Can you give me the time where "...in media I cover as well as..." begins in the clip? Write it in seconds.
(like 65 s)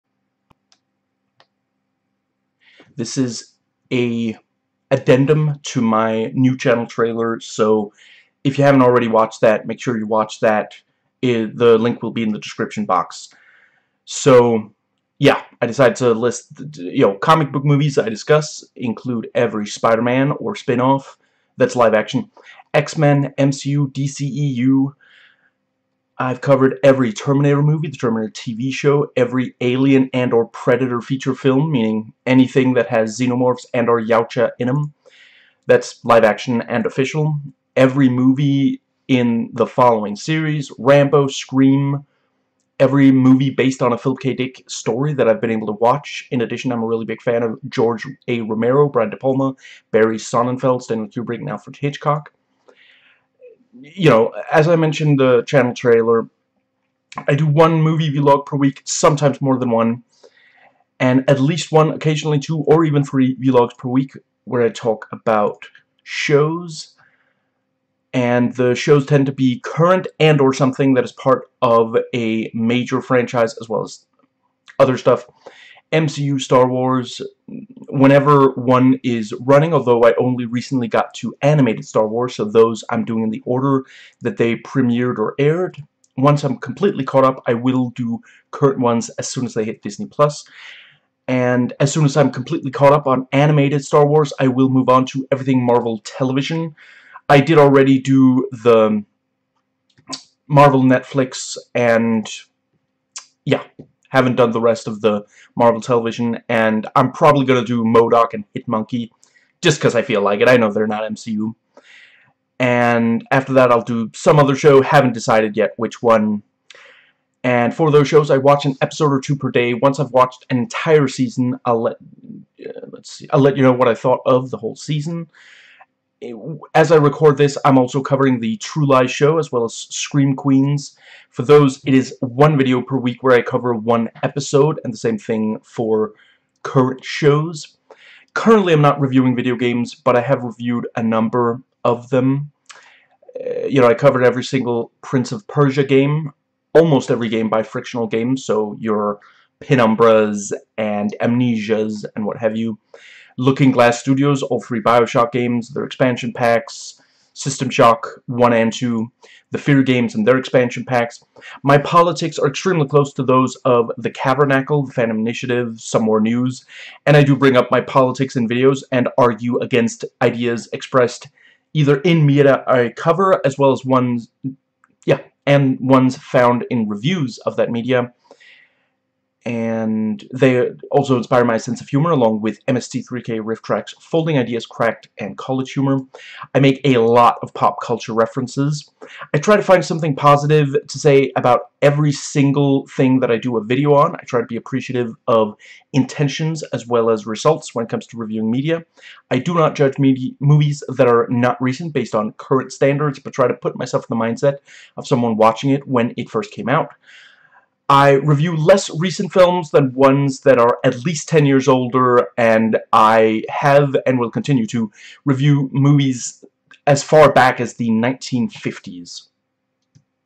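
172 s.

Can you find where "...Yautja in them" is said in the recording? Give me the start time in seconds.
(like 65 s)
33 s.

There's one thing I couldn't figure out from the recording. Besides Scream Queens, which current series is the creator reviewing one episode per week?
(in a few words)
True Lies.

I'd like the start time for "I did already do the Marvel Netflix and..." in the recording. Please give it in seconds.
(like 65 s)
97 s.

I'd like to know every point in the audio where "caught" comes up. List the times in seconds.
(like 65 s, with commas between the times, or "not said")
87 s, 92 s.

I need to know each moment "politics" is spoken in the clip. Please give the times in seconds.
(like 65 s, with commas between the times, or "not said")
161 s, 167 s.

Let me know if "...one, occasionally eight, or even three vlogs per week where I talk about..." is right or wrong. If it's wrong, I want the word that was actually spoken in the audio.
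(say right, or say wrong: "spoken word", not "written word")
wrong: "two", not "eight".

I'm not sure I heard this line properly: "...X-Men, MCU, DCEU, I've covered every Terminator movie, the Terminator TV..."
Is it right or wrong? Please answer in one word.
right.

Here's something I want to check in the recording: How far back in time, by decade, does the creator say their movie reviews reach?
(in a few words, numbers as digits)
1950s.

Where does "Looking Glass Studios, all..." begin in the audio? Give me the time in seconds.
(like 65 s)
153 s.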